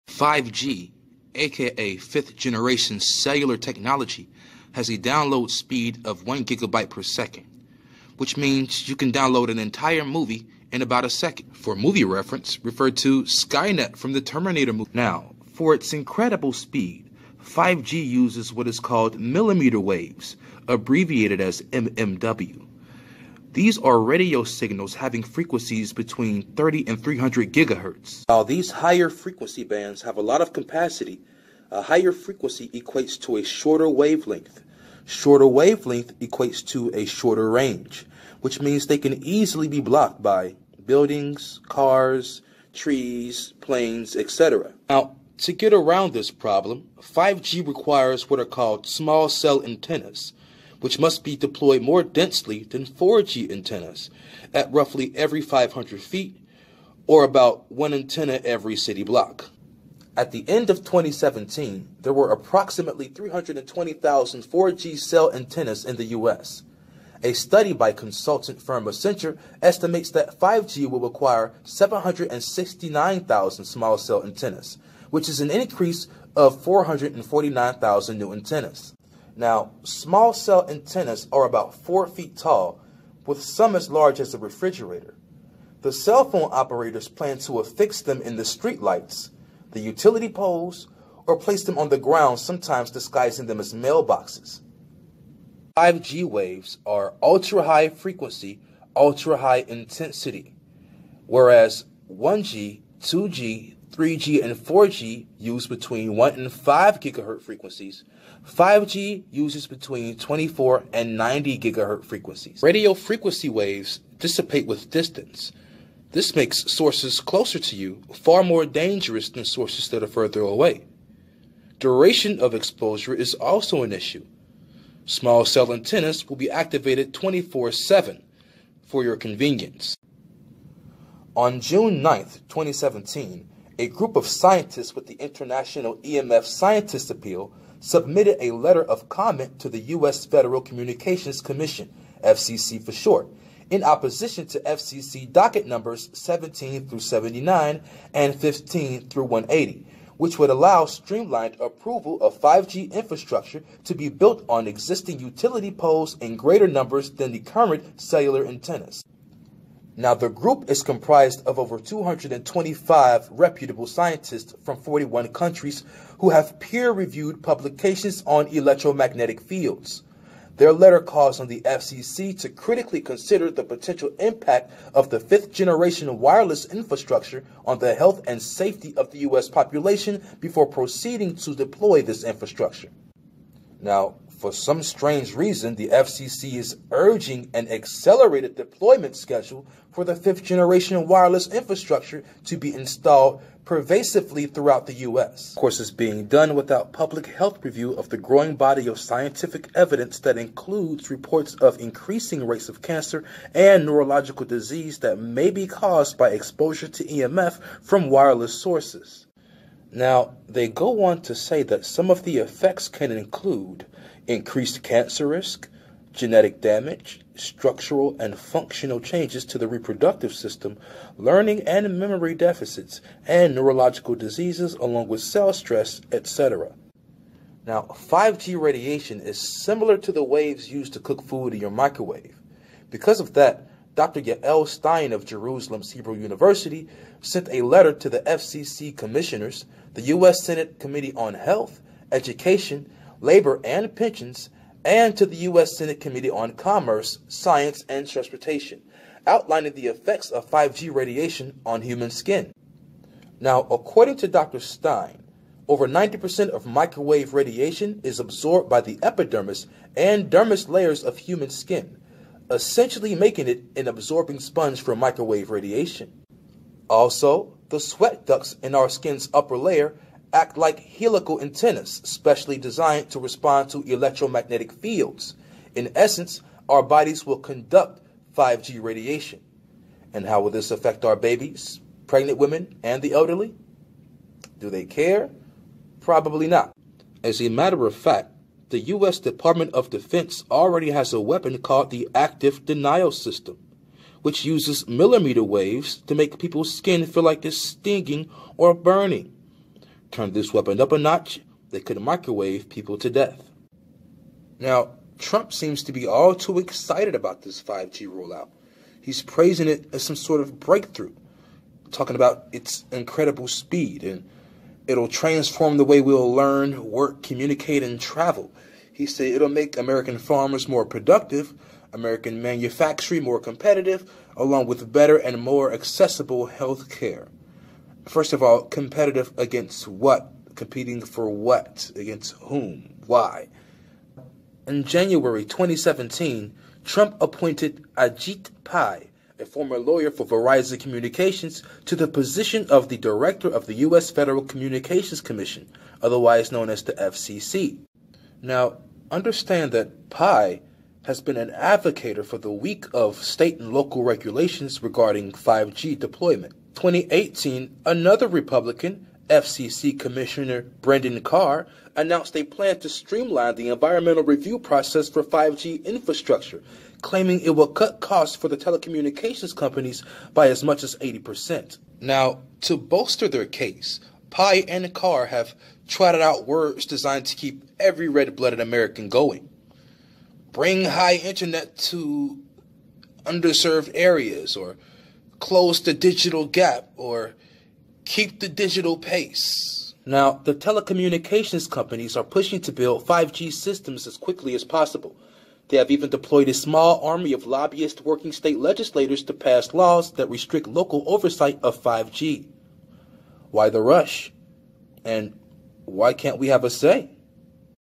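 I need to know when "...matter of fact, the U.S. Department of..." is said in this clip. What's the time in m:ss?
4:47.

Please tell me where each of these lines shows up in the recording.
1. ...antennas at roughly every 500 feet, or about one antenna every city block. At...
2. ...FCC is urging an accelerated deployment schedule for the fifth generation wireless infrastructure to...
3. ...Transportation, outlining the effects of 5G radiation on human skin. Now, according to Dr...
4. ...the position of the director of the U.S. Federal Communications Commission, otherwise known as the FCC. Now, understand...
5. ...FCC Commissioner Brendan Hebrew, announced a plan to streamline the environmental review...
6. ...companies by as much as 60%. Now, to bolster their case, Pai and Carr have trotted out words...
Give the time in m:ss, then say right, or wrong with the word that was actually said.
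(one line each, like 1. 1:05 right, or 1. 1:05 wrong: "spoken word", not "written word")
1. 0:53 right
2. 3:05 right
3. 4:08 right
4. 5:41 right
5. 5:59 wrong: "Carr", not "Hebrew"
6. 6:09 wrong: "80", not "60".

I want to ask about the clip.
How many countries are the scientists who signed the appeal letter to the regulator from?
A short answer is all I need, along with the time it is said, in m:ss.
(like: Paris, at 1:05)
41, at 2:44.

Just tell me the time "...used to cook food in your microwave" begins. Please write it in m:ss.
3:50.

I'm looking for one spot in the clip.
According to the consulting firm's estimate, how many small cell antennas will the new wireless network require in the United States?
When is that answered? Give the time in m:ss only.
1:11.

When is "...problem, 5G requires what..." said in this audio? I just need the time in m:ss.
0:46.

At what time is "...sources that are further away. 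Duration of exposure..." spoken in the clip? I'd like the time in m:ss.
1:59.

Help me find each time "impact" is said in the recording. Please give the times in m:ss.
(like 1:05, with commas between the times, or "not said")
2:54.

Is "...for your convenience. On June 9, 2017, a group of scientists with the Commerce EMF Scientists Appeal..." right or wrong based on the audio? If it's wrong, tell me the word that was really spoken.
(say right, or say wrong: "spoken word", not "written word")
wrong: "International", not "Commerce".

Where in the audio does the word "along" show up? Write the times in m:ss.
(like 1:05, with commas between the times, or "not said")
3:44, 5:24.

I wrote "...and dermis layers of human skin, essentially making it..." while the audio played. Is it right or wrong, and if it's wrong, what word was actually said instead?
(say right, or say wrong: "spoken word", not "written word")
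right.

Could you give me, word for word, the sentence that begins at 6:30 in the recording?
Now, the telecommunications companies are pushing to build 5G systems as quickly as possible.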